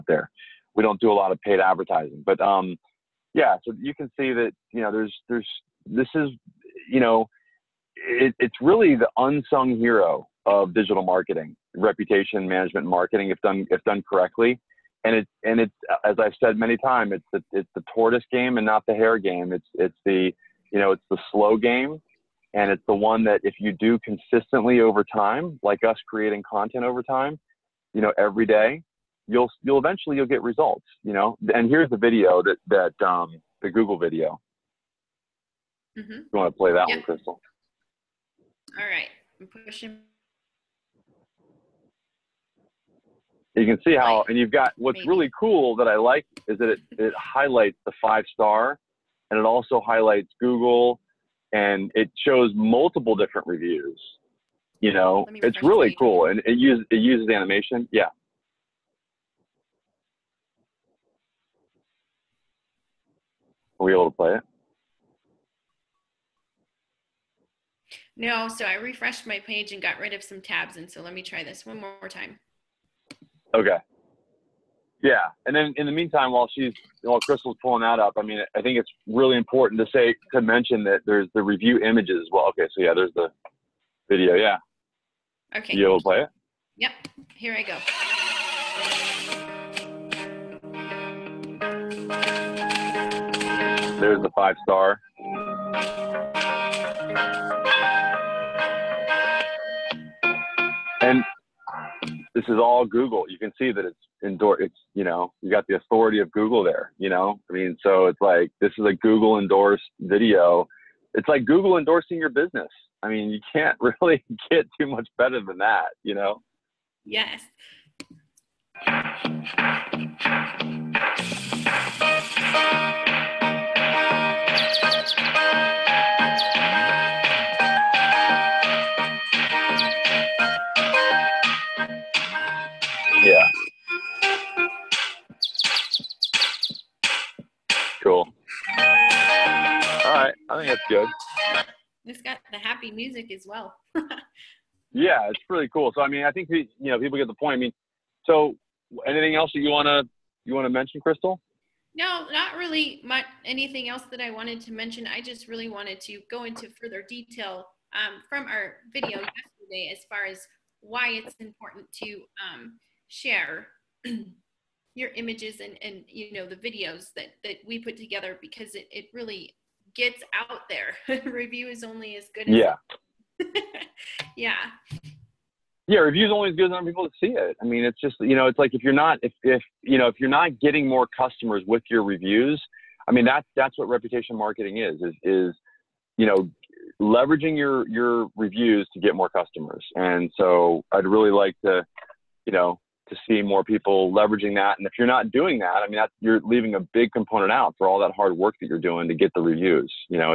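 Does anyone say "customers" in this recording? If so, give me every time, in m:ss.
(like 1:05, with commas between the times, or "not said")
3:01, 3:09.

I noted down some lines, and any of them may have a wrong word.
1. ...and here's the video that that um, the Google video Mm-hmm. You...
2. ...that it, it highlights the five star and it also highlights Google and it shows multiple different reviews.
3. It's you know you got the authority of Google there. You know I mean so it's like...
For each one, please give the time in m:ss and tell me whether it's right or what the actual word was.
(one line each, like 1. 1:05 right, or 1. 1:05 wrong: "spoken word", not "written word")
1. 0:31 right
2. 0:46 right
3. 1:44 right.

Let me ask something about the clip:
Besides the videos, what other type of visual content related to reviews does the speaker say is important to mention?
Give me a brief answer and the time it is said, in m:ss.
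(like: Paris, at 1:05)
Review images, at 1:21.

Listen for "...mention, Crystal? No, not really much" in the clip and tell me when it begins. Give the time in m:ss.
2:30.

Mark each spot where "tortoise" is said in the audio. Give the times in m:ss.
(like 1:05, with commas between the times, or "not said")
0:17.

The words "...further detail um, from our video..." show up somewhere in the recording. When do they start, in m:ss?
2:36.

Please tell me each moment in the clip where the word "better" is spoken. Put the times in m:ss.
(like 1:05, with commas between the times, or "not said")
1:55.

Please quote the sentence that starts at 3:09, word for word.
And so I'd really like to you know to see more people leveraging that.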